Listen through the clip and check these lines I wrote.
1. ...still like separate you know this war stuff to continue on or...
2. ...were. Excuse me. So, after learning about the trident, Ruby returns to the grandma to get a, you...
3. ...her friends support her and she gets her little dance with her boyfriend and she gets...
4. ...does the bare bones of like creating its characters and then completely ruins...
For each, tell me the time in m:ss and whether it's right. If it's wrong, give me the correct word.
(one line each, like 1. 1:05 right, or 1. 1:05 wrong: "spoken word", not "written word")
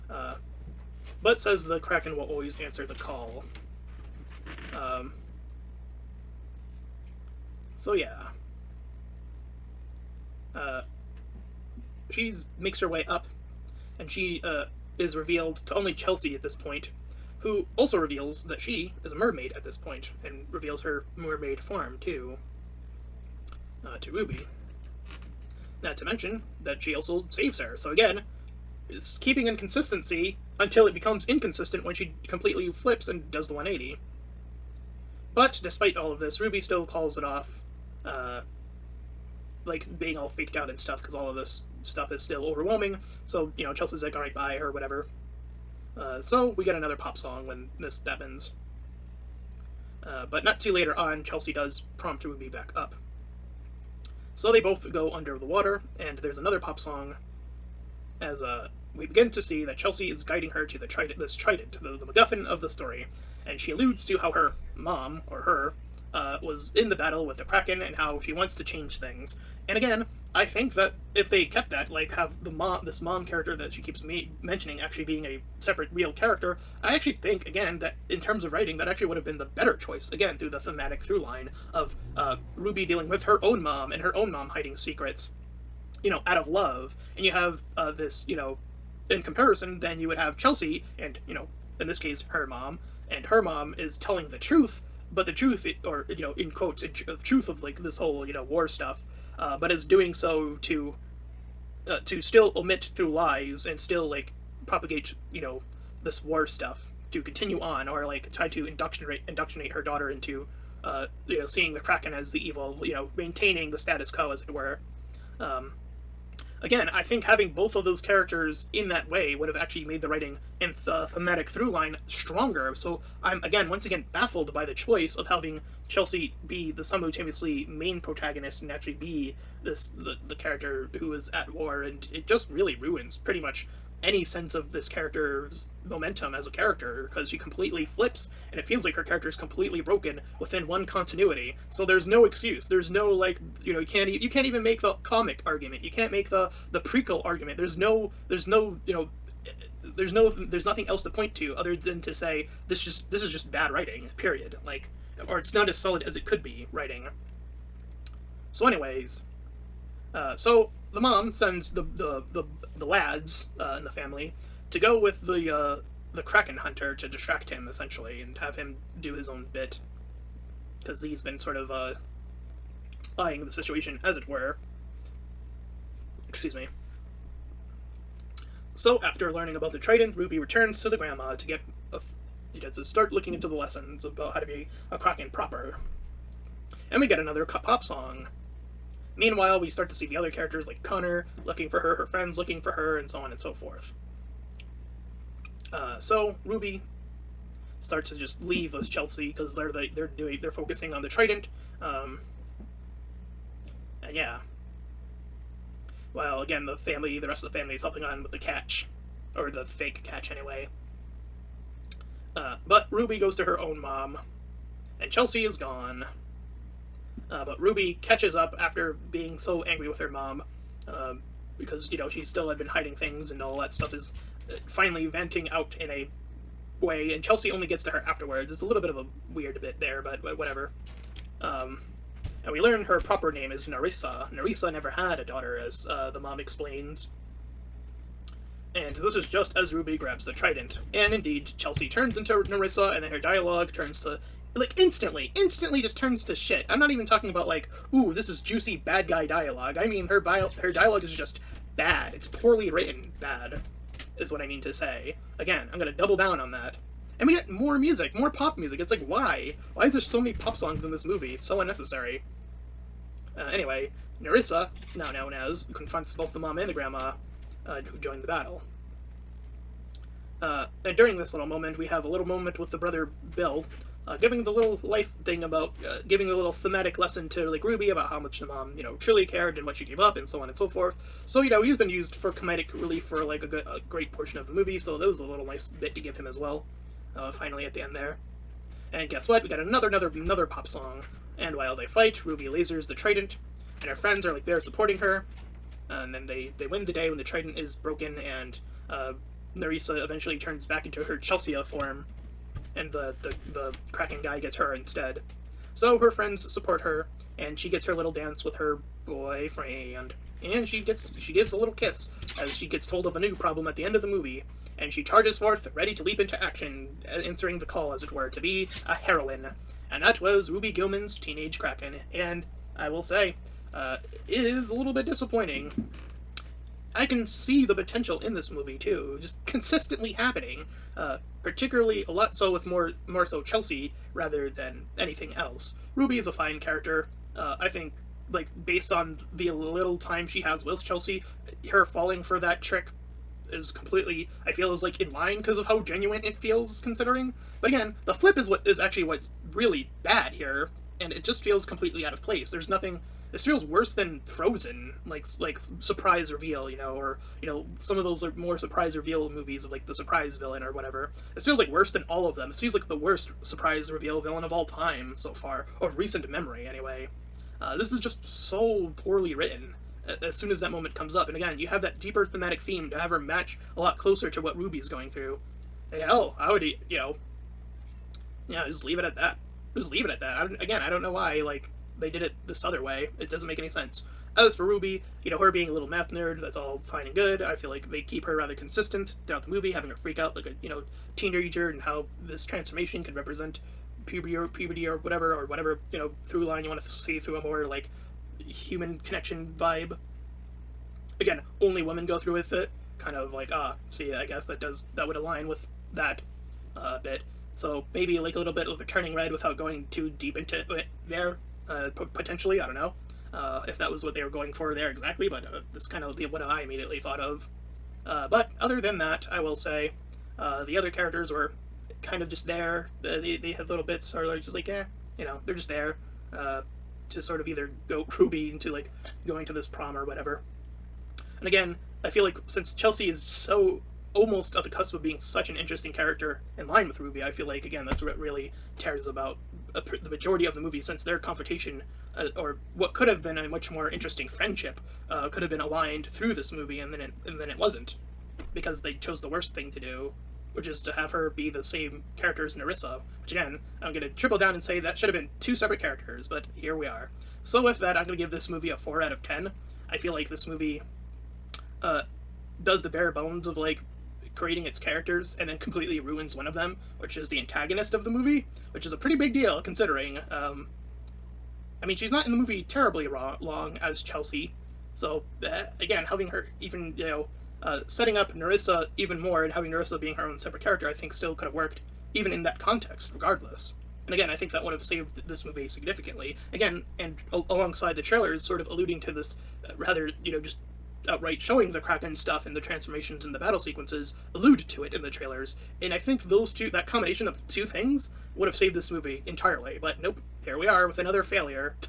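1. 1:43 wrong: "propagate", not "separate"
2. 2:54 right
3. 5:05 right
4. 7:42 right.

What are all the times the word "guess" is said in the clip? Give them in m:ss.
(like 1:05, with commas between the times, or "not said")
4:49, 6:44.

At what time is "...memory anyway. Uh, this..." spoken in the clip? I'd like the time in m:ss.
6:06.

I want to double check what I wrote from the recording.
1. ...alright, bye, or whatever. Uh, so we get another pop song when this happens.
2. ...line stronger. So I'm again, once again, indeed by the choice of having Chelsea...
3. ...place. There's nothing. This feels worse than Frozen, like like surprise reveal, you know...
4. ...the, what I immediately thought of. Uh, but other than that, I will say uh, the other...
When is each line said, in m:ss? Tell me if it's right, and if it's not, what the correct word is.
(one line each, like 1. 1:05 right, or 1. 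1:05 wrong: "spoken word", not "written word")
1. 0:44 right
2. 2:01 wrong: "baffled", not "indeed"
3. 5:52 right
4. 6:56 right.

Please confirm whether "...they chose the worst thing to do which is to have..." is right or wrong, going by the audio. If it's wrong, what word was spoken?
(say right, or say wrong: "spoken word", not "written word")
right.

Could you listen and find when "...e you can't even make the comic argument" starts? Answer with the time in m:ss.
2:24.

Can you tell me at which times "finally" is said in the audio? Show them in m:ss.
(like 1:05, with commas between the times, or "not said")
3:44, 4:47.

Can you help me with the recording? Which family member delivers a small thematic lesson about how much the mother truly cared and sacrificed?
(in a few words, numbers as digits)
Bill.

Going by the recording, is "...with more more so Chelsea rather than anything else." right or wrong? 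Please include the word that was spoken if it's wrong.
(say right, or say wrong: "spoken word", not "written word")
right.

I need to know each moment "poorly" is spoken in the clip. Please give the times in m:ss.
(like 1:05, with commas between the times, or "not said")
4:12, 6:09.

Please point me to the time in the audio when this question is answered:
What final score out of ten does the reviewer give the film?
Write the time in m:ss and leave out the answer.
7:38.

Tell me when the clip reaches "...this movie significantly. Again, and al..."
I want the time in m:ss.
8:05.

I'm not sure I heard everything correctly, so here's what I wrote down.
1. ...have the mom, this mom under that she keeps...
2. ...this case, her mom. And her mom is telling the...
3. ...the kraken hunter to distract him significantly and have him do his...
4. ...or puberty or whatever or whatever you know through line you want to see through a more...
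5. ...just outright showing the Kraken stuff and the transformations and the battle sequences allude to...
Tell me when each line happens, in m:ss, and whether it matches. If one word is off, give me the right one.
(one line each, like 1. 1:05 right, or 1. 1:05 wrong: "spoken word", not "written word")
1. 1:12 wrong: "character", not "under"
2. 1:31 right
3. 2:46 wrong: "essentially", not "significantly"
4. 6:34 right
5. 8:10 right.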